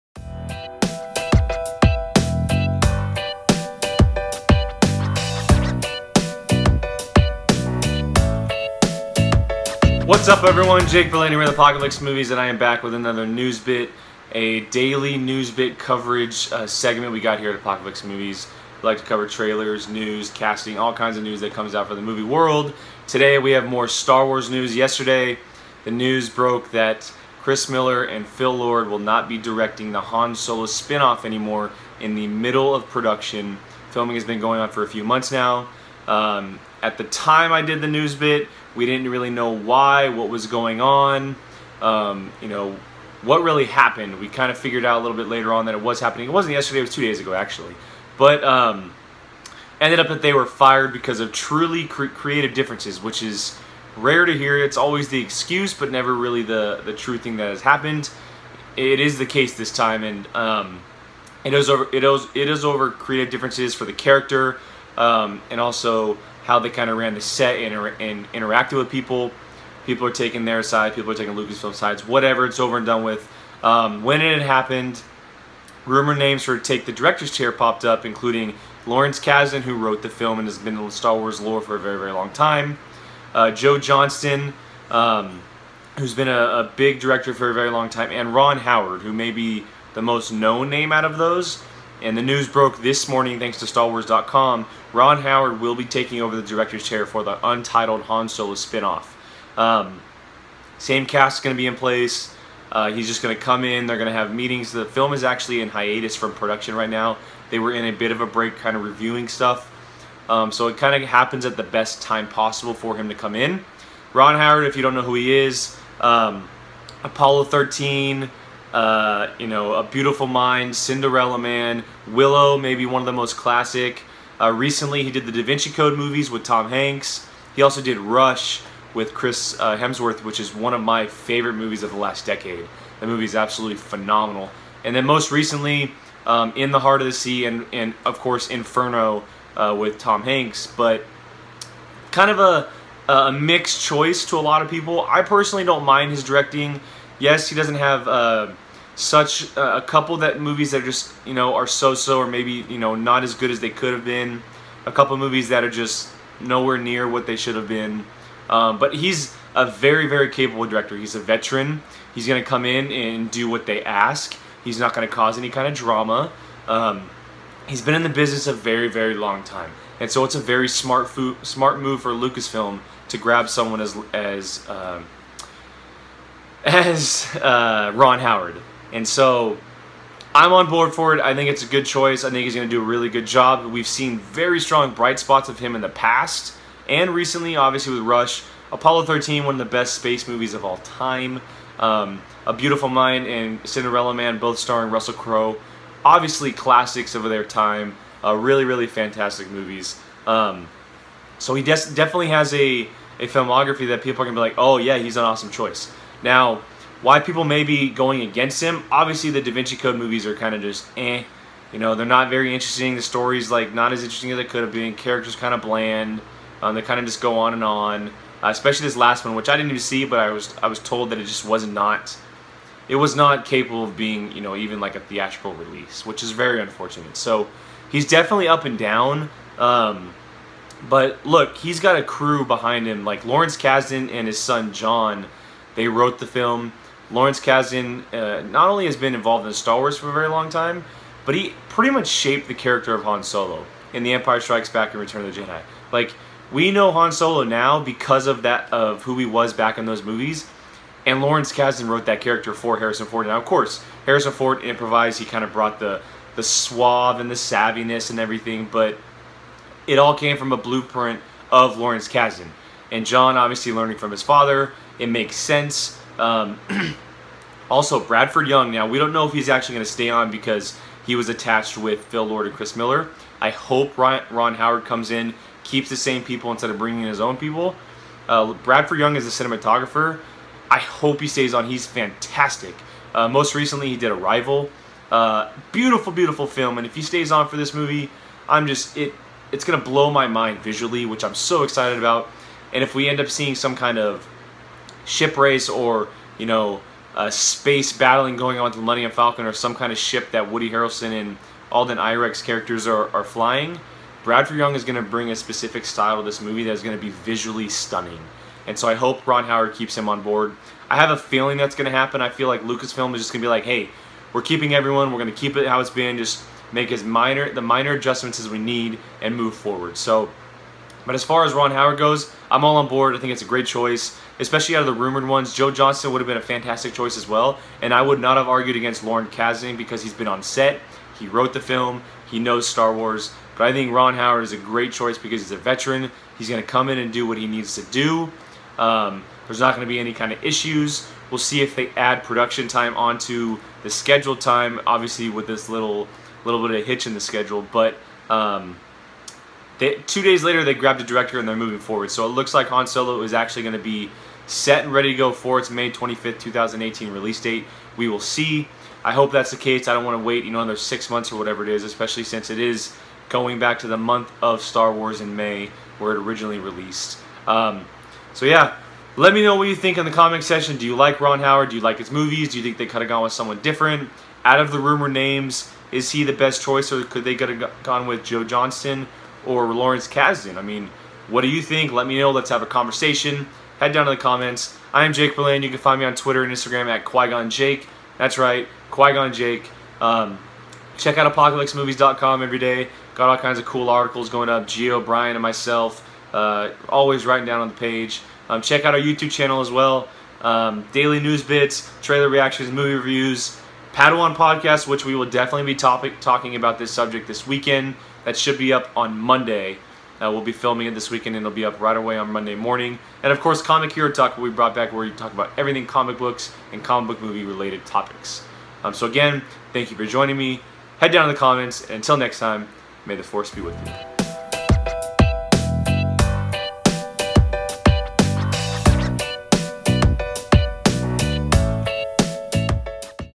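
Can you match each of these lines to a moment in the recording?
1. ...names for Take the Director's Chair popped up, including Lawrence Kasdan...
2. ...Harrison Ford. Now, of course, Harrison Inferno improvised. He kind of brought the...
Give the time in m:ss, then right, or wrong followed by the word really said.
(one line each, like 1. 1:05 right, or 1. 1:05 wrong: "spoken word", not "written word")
1. 1:16 right
2. 4:12 wrong: "Ford", not "Inferno".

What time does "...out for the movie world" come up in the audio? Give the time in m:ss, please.
0:21.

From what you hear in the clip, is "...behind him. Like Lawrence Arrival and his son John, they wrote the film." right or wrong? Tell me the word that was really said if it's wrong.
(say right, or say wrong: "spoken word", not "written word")
wrong: "Kasdan", not "Arrival".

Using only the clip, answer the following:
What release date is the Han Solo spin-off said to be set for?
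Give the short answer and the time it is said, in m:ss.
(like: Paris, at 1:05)
May 25th, 2018, at 5:55.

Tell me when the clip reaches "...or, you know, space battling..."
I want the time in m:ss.
4:55.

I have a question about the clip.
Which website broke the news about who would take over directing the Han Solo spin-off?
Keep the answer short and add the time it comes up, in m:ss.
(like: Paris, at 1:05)
StarWars.com, at 1:33.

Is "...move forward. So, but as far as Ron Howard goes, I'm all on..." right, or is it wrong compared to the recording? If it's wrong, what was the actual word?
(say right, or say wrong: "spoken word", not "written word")
right.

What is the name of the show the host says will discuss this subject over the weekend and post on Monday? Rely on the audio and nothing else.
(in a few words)
Padawan podcast.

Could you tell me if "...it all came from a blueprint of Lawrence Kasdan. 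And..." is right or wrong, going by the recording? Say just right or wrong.
right.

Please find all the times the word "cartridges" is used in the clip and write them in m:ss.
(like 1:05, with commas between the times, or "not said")
not said.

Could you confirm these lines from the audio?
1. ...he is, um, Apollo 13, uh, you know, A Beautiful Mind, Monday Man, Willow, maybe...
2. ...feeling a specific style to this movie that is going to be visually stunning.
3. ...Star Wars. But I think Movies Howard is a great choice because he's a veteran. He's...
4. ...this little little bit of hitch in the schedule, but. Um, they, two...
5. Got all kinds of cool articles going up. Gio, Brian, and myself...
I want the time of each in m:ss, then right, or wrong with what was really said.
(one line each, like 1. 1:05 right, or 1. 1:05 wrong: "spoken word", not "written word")
1. 1:55 wrong: "Cinderella", not "Monday"
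2. 5:05 wrong: "bring", not "feeling"
3. 5:32 wrong: "Ron", not "Movies"
4. 5:45 right
5. 6:33 right.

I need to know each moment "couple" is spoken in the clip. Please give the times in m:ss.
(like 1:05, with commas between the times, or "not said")
2:29, 2:34.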